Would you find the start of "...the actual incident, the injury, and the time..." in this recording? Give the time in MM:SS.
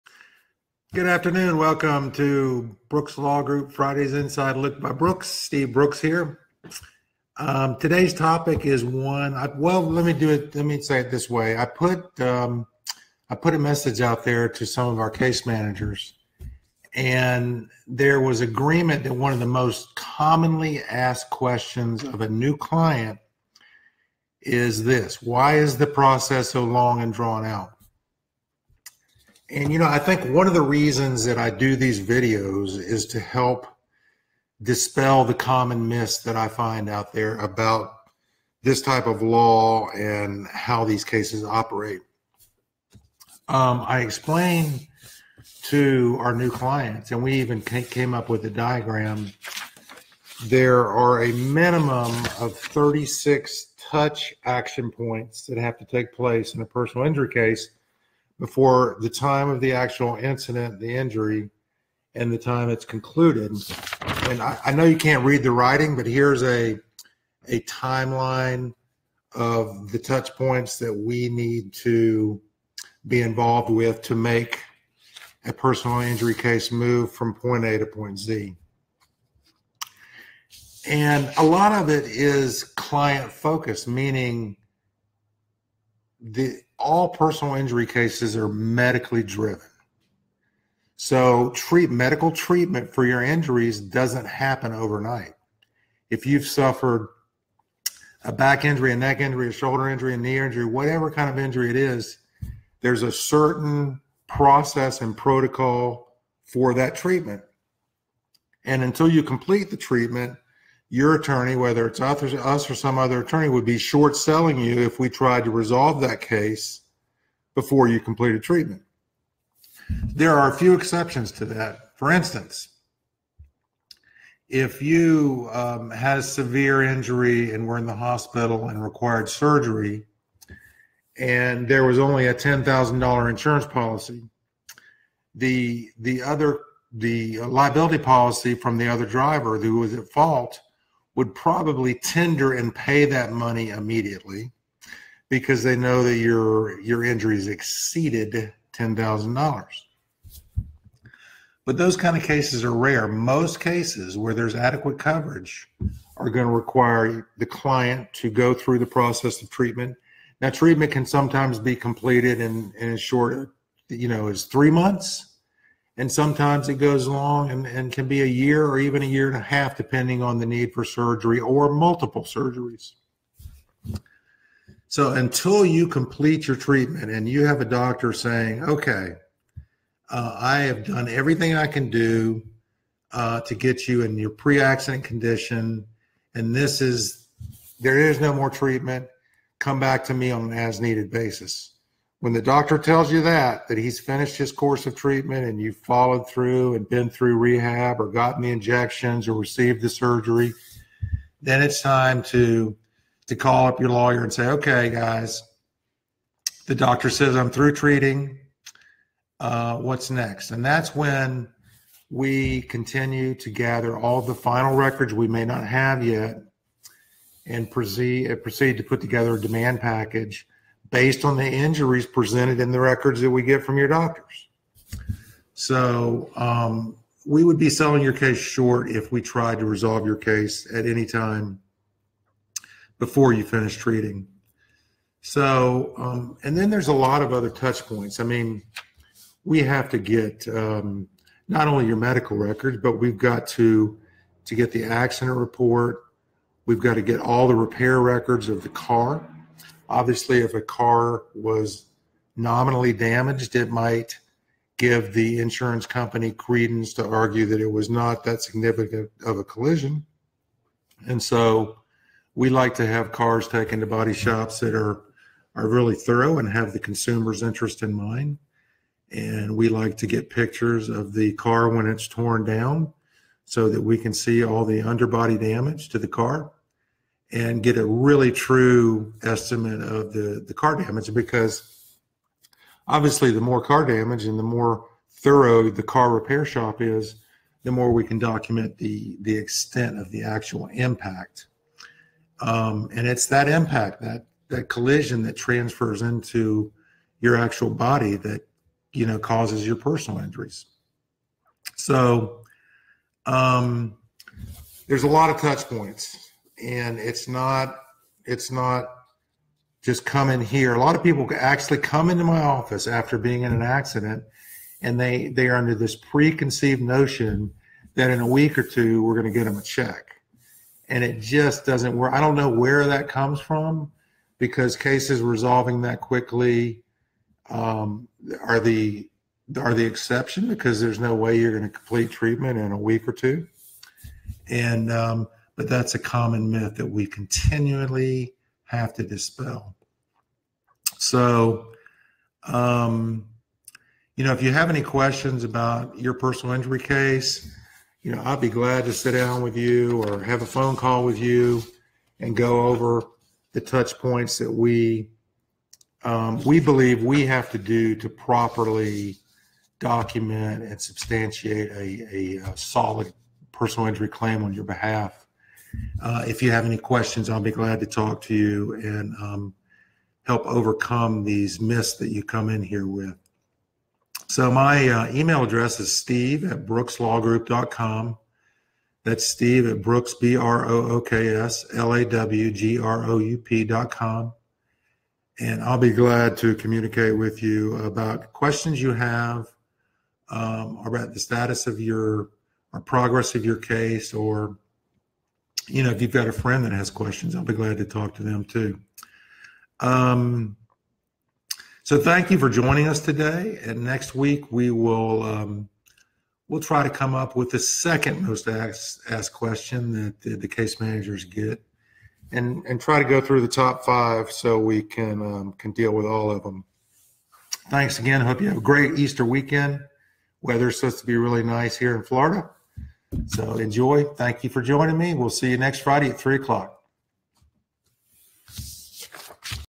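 00:59.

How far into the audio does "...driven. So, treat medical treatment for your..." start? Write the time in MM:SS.
01:29.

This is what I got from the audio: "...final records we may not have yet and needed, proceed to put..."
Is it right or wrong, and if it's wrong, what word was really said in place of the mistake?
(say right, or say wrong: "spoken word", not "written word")
wrong: "proceed", not "needed".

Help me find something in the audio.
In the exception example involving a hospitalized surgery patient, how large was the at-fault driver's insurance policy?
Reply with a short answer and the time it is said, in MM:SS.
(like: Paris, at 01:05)
$10,000, at 02:12.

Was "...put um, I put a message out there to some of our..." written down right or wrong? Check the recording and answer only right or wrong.
right.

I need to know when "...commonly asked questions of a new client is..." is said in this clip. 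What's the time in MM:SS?
00:19.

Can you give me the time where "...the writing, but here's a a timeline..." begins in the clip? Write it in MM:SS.
01:05.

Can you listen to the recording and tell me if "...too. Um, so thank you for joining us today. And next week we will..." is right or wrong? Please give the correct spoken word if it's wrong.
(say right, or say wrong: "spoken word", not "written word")
right.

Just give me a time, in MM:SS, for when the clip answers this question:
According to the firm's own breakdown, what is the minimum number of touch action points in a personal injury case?
00:52.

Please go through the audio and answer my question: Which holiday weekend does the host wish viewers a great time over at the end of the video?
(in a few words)
Easter.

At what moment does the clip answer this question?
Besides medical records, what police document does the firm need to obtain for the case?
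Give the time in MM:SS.
04:04.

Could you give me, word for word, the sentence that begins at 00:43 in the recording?
Um, I explain to our new clients, and we even came up with a diagram.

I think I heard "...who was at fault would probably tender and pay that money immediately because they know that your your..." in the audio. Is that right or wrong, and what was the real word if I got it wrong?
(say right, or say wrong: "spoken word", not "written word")
right.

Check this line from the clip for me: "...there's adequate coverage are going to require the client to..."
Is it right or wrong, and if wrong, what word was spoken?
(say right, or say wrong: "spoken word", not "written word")
right.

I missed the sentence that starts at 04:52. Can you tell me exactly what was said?
Um, and it's that impact, that, that collision that transfers into your actual body that, you know, causes your personal injuries.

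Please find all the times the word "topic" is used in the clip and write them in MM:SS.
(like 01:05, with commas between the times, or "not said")
00:08.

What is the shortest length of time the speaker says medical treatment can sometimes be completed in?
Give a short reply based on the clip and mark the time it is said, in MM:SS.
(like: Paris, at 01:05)
3 months, at 02:44.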